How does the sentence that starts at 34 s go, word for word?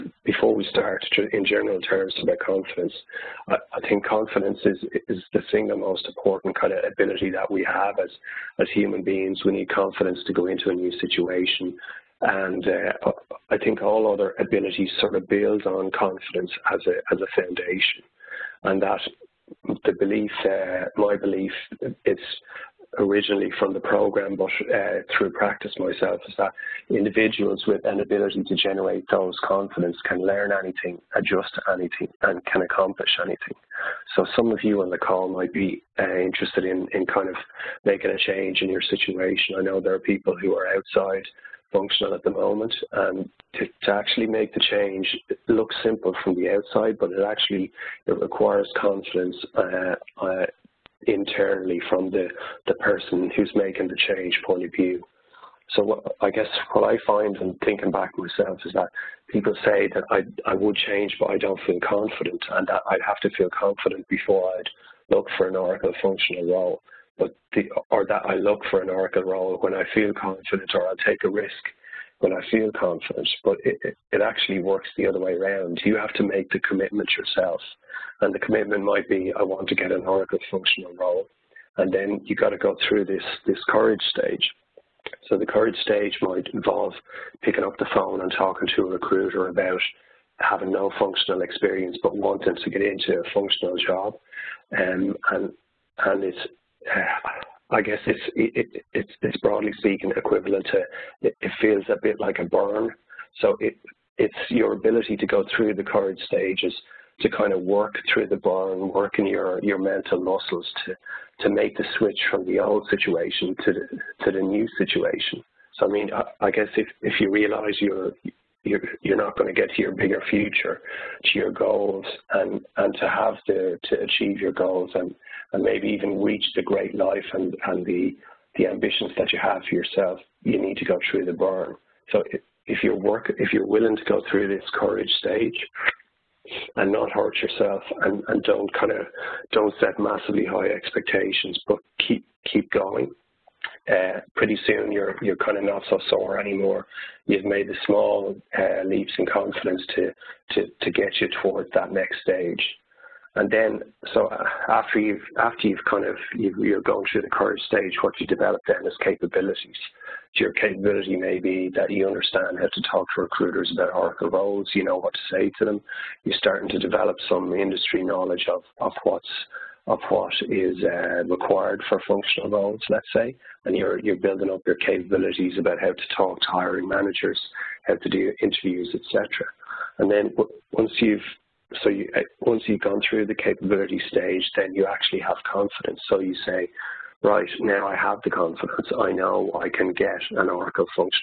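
So some of you on the call might be uh, interested in, in kind of making a change in your situation.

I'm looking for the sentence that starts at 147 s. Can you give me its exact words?
You've made the small uh, leaps in confidence to to to get you towards that next stage.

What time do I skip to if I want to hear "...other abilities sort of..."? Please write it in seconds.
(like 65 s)
14 s.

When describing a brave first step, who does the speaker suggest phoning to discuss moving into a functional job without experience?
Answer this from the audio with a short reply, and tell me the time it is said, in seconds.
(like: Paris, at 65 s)
A recruiter, at 88 s.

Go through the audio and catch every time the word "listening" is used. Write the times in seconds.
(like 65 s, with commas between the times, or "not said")
not said.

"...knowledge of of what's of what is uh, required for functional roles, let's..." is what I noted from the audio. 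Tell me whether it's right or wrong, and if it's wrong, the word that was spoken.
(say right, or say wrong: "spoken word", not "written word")
right.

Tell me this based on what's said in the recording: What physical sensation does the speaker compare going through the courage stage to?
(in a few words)
A burn.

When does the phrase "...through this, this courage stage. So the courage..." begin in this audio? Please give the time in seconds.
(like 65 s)
82 s.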